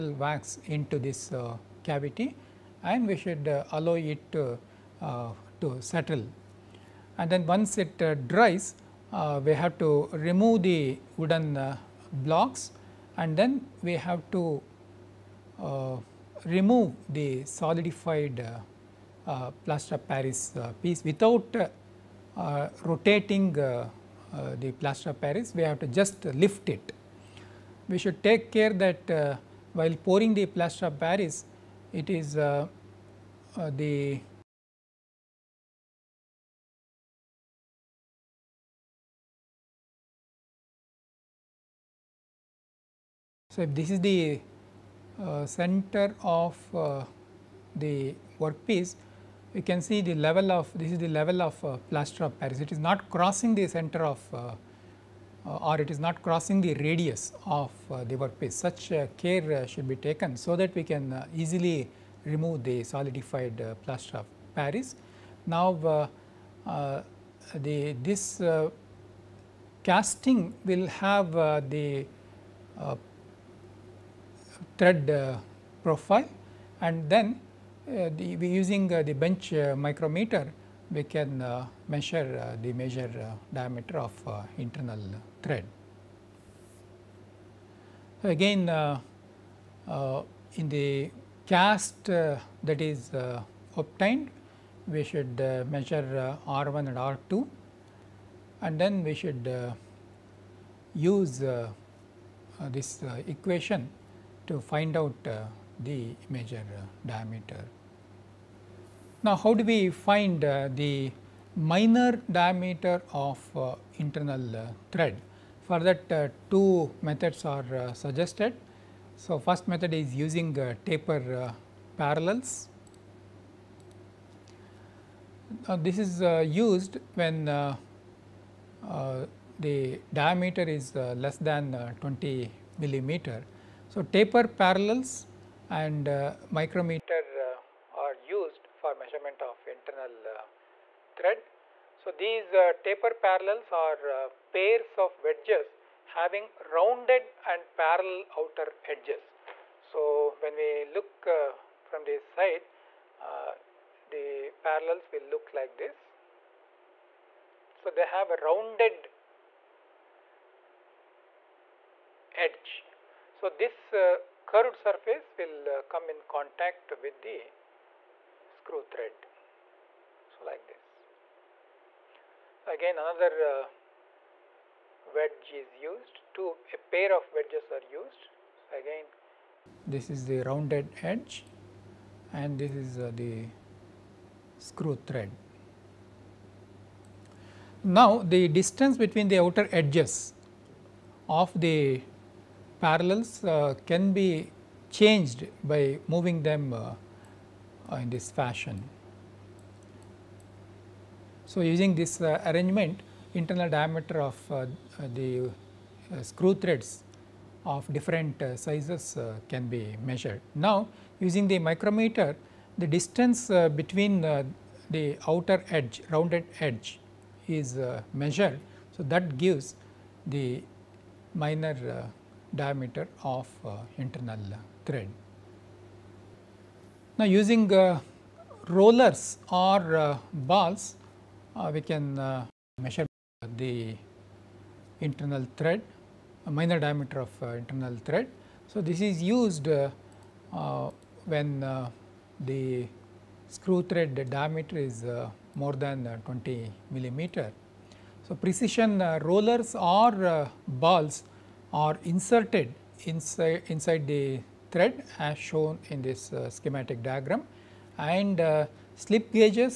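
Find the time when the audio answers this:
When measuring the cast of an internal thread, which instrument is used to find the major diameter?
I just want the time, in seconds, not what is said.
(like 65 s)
79 s.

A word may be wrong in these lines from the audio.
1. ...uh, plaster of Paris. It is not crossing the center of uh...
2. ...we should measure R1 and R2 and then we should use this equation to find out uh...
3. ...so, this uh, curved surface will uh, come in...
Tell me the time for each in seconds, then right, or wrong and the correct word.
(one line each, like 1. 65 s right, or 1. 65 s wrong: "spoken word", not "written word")
1. 51 s right
2. 94 s right
3. 163 s right.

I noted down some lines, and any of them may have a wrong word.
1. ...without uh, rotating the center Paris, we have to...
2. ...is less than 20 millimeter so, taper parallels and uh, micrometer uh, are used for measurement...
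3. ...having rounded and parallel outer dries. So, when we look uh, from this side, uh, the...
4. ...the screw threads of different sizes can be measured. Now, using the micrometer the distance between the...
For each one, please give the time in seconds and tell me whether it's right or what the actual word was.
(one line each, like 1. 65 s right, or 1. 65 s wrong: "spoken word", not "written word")
1. 21 s wrong: "plaster", not "center"
2. 130 s right
3. 146 s wrong: "edges", not "dries"
4. 205 s right.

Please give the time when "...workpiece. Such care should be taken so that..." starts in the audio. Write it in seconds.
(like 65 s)
58 s.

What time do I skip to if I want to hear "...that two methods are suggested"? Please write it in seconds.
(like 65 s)
115 s.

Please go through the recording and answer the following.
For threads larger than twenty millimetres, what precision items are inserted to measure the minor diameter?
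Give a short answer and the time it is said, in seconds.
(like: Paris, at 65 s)
Rollers or balls, at 228 s.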